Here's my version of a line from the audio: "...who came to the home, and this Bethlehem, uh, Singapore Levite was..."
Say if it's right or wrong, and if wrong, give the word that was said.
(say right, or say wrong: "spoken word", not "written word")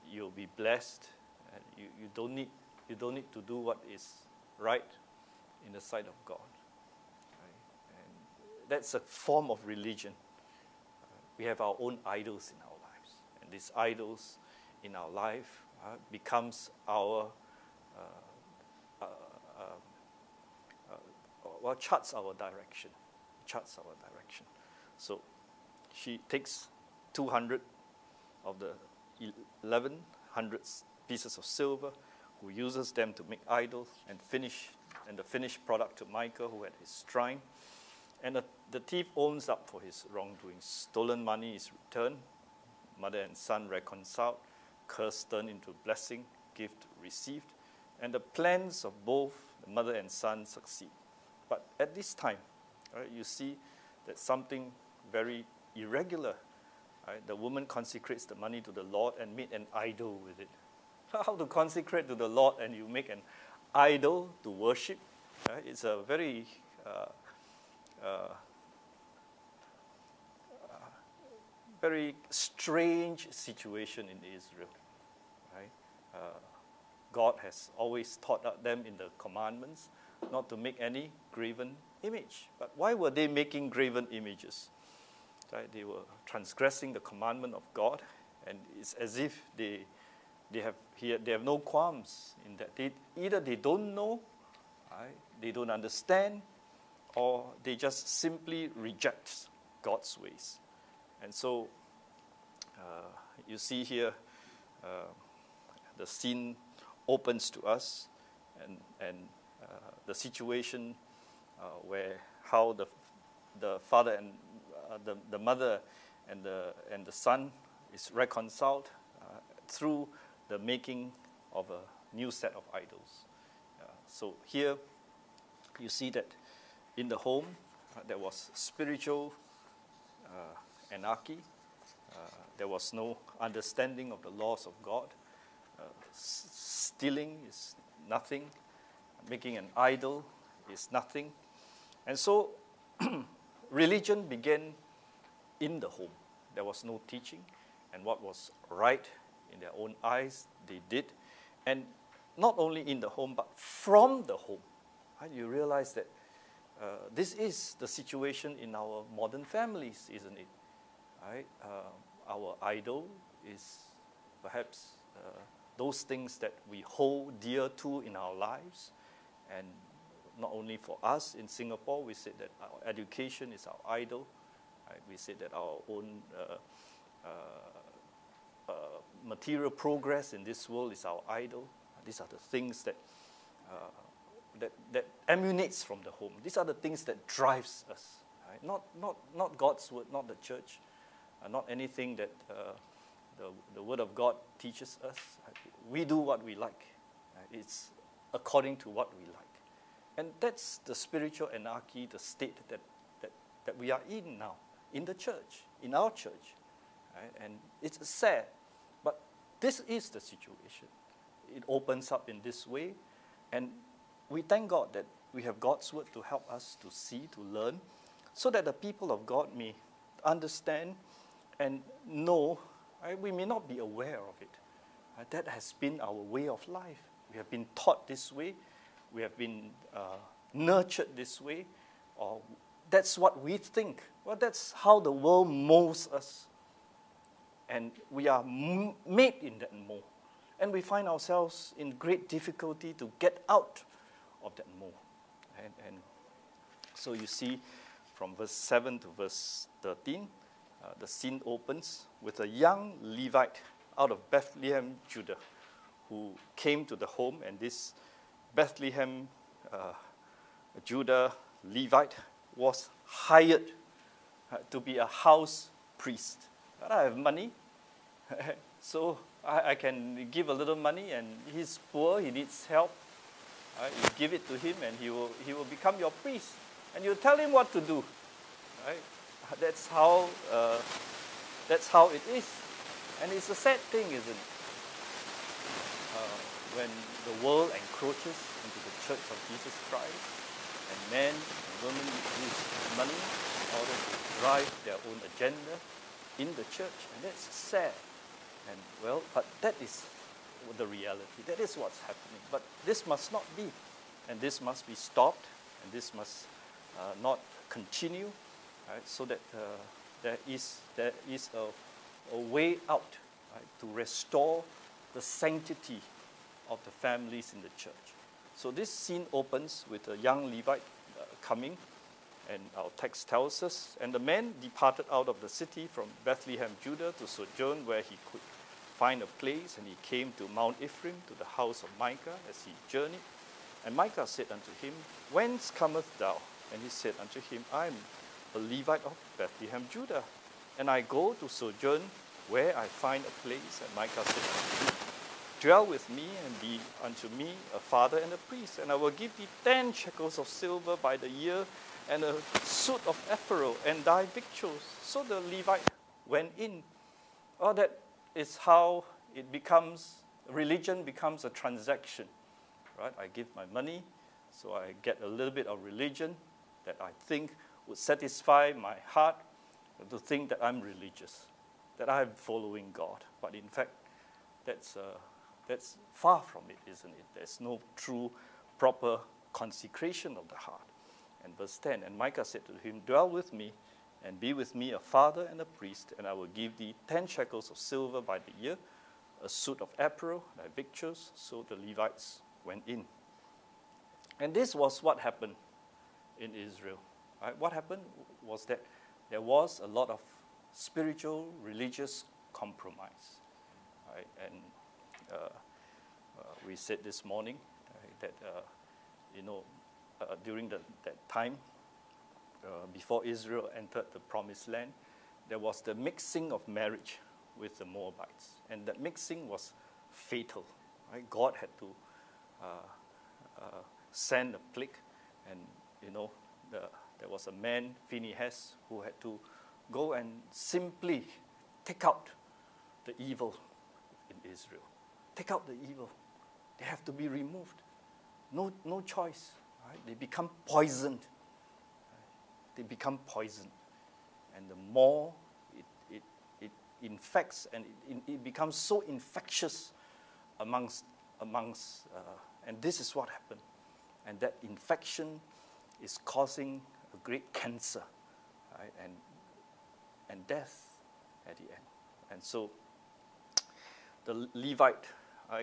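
wrong: "Judah", not "Singapore".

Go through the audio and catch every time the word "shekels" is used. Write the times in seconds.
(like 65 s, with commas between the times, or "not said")
349 s, 387 s.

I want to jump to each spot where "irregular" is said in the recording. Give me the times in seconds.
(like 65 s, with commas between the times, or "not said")
55 s.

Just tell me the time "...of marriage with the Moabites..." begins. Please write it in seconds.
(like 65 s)
416 s.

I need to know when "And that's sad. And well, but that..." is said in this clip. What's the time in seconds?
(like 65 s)
297 s.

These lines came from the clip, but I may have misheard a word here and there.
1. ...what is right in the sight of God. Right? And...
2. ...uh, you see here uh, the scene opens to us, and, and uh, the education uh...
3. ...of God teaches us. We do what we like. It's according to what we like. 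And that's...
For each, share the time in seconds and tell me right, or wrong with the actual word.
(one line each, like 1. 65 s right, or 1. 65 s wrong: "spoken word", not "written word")
1. 3 s right
2. 102 s wrong: "situation", not "education"
3. 194 s right.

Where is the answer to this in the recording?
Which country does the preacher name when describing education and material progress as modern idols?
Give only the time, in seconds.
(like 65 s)
171 s.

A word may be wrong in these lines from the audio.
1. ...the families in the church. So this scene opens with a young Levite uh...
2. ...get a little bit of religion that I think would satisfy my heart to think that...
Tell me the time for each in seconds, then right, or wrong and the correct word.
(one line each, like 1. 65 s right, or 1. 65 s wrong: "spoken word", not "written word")
1. 316 s right
2. 365 s right.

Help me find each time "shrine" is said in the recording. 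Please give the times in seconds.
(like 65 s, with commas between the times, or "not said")
37 s.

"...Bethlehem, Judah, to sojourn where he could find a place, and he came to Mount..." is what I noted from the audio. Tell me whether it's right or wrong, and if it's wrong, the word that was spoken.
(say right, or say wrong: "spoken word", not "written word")
right.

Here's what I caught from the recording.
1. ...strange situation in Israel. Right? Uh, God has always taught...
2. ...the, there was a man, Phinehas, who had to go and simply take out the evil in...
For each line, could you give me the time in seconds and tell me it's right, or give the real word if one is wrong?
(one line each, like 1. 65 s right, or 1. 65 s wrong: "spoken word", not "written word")
1. 72 s right
2. 426 s right.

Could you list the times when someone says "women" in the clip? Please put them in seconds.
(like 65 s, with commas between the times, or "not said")
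291 s.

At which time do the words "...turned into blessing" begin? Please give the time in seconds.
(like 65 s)
45 s.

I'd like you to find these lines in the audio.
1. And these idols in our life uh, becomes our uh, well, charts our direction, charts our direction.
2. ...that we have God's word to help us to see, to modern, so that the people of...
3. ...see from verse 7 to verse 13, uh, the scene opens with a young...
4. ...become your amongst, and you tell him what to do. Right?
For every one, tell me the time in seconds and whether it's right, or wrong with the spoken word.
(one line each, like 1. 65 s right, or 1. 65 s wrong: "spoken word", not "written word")
1. 13 s right
2. 214 s wrong: "learn", not "modern"
3. 247 s right
4. 275 s wrong: "priest", not "amongst".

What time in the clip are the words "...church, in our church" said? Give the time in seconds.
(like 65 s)
205 s.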